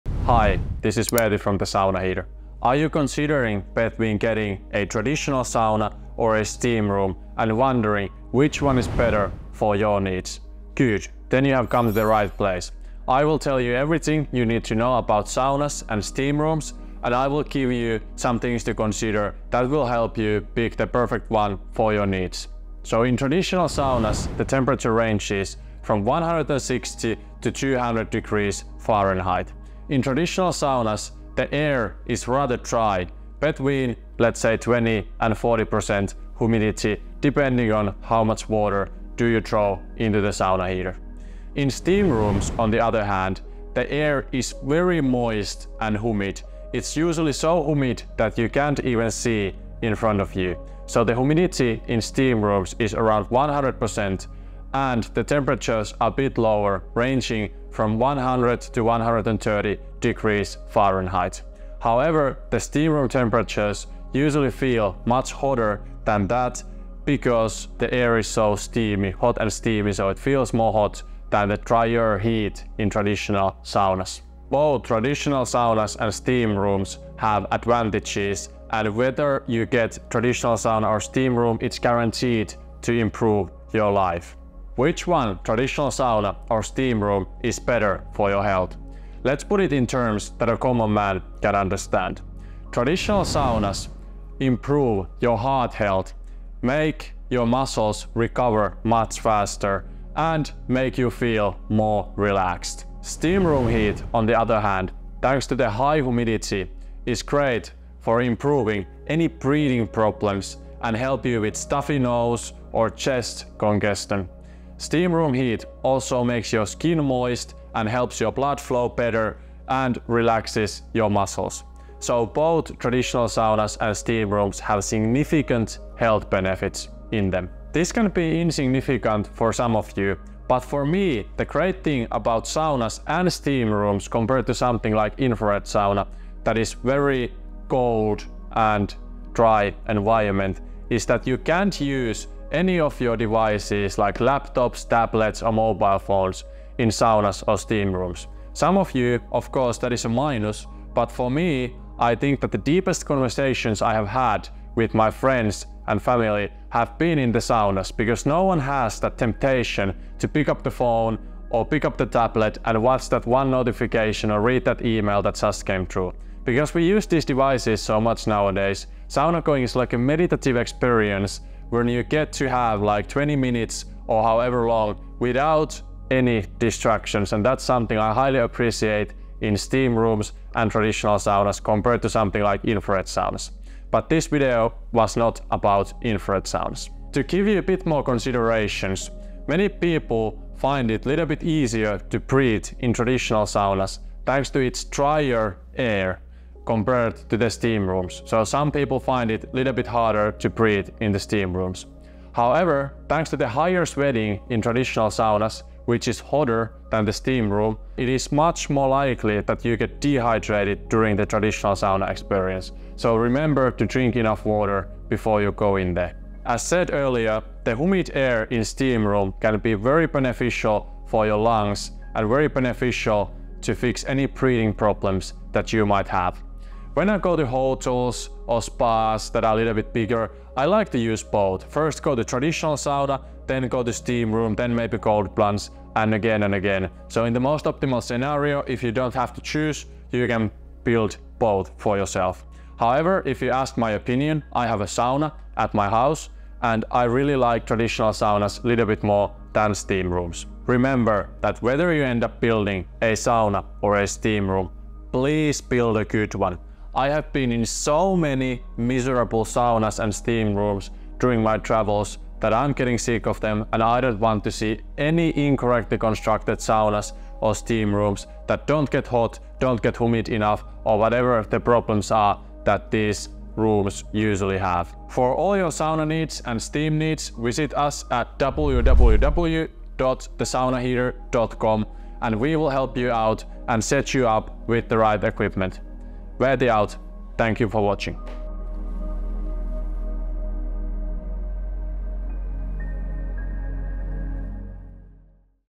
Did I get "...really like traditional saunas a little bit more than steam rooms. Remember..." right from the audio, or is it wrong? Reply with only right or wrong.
right.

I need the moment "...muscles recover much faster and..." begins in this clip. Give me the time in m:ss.
1:37.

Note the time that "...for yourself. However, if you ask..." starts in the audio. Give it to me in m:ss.
4:01.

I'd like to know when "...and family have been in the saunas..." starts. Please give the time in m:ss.
2:35.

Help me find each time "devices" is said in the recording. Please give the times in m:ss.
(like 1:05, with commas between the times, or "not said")
2:23, 2:47.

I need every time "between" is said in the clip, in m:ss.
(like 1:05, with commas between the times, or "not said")
0:03, 0:33.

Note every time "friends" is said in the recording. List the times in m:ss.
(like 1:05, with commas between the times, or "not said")
2:35.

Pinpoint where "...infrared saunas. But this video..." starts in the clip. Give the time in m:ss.
3:02.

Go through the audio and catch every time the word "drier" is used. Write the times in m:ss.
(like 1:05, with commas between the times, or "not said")
1:11, 3:14.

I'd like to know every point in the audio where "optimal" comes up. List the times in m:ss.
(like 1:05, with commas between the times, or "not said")
3:57.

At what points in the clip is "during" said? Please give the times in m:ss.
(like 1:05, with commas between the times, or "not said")
3:30, 4:21.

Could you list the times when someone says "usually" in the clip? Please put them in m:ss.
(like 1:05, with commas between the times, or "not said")
0:46, 1:04, 4:34.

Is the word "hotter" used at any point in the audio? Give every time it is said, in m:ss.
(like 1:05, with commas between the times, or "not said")
1:05, 3:26.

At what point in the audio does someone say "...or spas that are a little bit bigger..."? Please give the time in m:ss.
3:48.